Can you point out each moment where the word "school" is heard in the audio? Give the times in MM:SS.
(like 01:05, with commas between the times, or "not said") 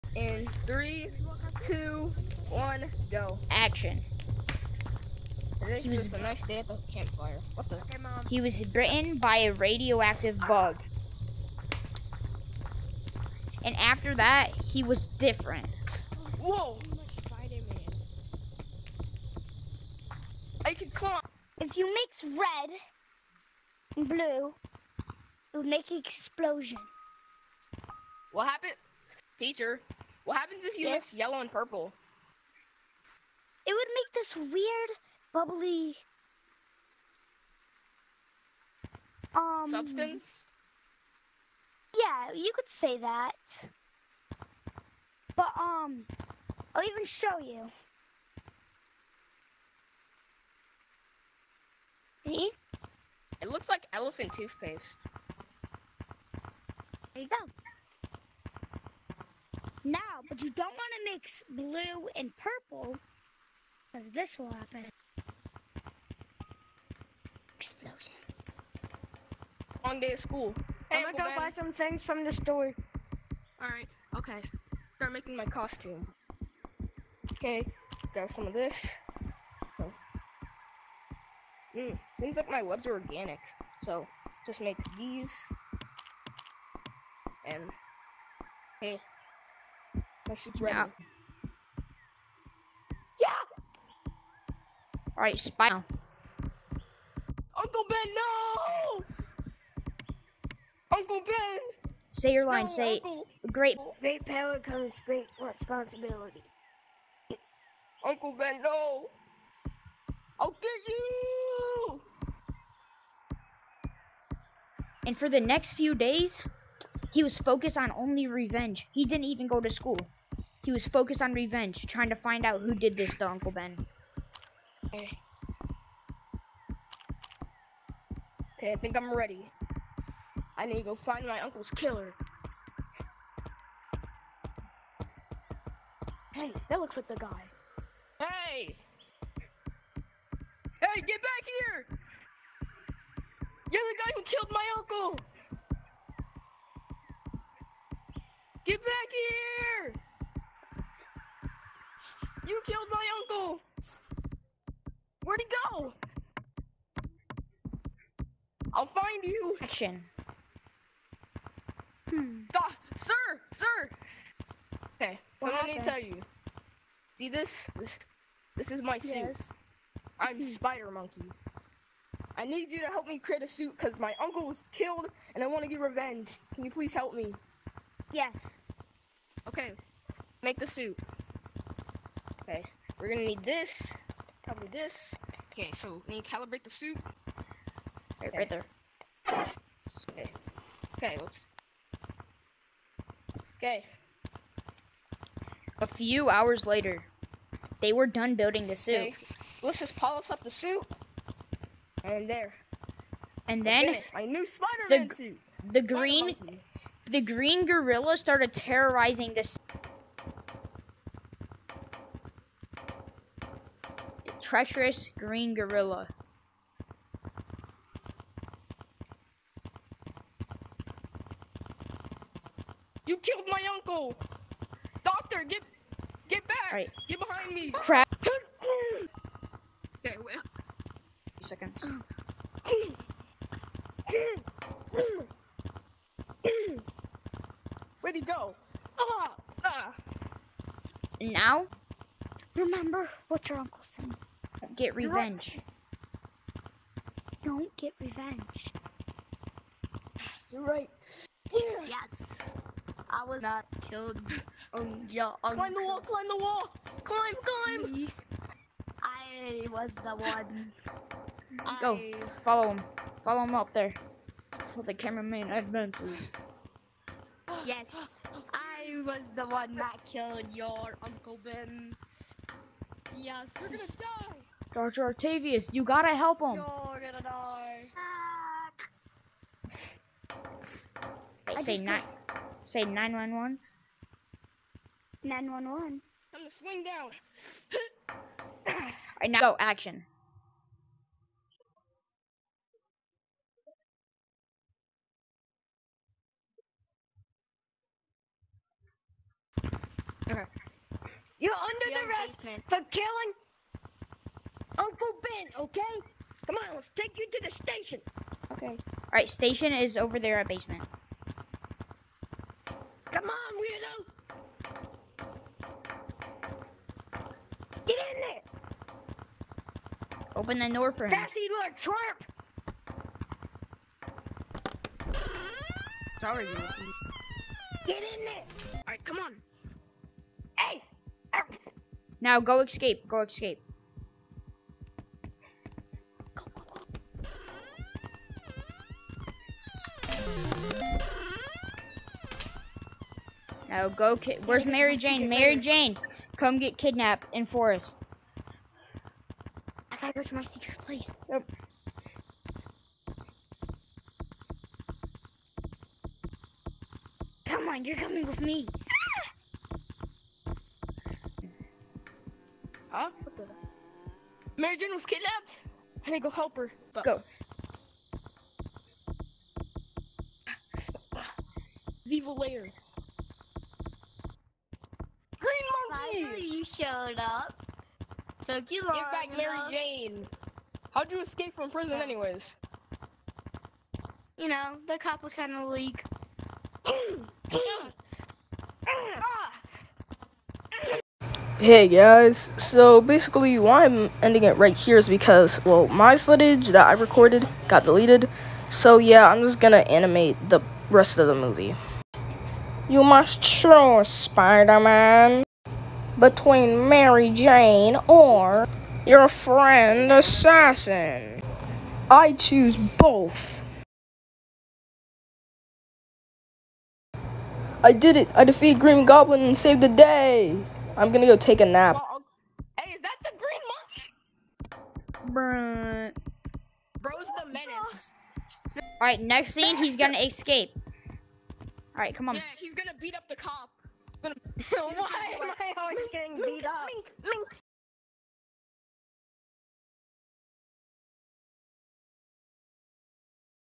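01:10, 01:59.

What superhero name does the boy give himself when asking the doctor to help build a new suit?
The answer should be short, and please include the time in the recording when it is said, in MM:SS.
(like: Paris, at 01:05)
Spider Monkey, at 02:50.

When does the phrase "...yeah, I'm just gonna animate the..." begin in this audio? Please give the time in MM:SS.
06:38.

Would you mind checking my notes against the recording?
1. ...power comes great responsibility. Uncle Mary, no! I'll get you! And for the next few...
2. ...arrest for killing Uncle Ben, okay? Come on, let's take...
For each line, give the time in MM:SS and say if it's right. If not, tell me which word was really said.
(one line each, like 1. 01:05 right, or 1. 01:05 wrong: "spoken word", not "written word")
1. 01:44 wrong: "Ben", not "Mary"
2. 05:02 right.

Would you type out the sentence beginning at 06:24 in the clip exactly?
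You know, the cop was kind of weak.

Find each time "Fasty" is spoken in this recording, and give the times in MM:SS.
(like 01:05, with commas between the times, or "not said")
05:21.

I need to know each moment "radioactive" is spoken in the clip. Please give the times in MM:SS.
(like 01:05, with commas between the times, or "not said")
00:09.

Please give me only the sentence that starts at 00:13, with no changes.
And after that, he was different.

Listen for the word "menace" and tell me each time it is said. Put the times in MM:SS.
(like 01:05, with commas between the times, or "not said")
07:07.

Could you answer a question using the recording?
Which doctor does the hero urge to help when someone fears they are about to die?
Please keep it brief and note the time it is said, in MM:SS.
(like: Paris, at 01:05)
Dr. Octavius, at 04:35.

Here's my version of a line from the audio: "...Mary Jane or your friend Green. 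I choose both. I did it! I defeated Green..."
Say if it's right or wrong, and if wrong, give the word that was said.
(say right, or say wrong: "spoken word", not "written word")
wrong: "Assassin", not "Green".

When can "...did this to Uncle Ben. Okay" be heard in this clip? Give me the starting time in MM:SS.
02:02.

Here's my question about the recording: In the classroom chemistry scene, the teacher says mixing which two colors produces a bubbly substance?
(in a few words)
Yellow and purple.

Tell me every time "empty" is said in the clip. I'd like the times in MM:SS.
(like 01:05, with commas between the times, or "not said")
not said.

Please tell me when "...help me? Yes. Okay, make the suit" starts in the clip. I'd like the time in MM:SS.
02:56.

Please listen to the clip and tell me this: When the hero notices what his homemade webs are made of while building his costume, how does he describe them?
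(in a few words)
Organic.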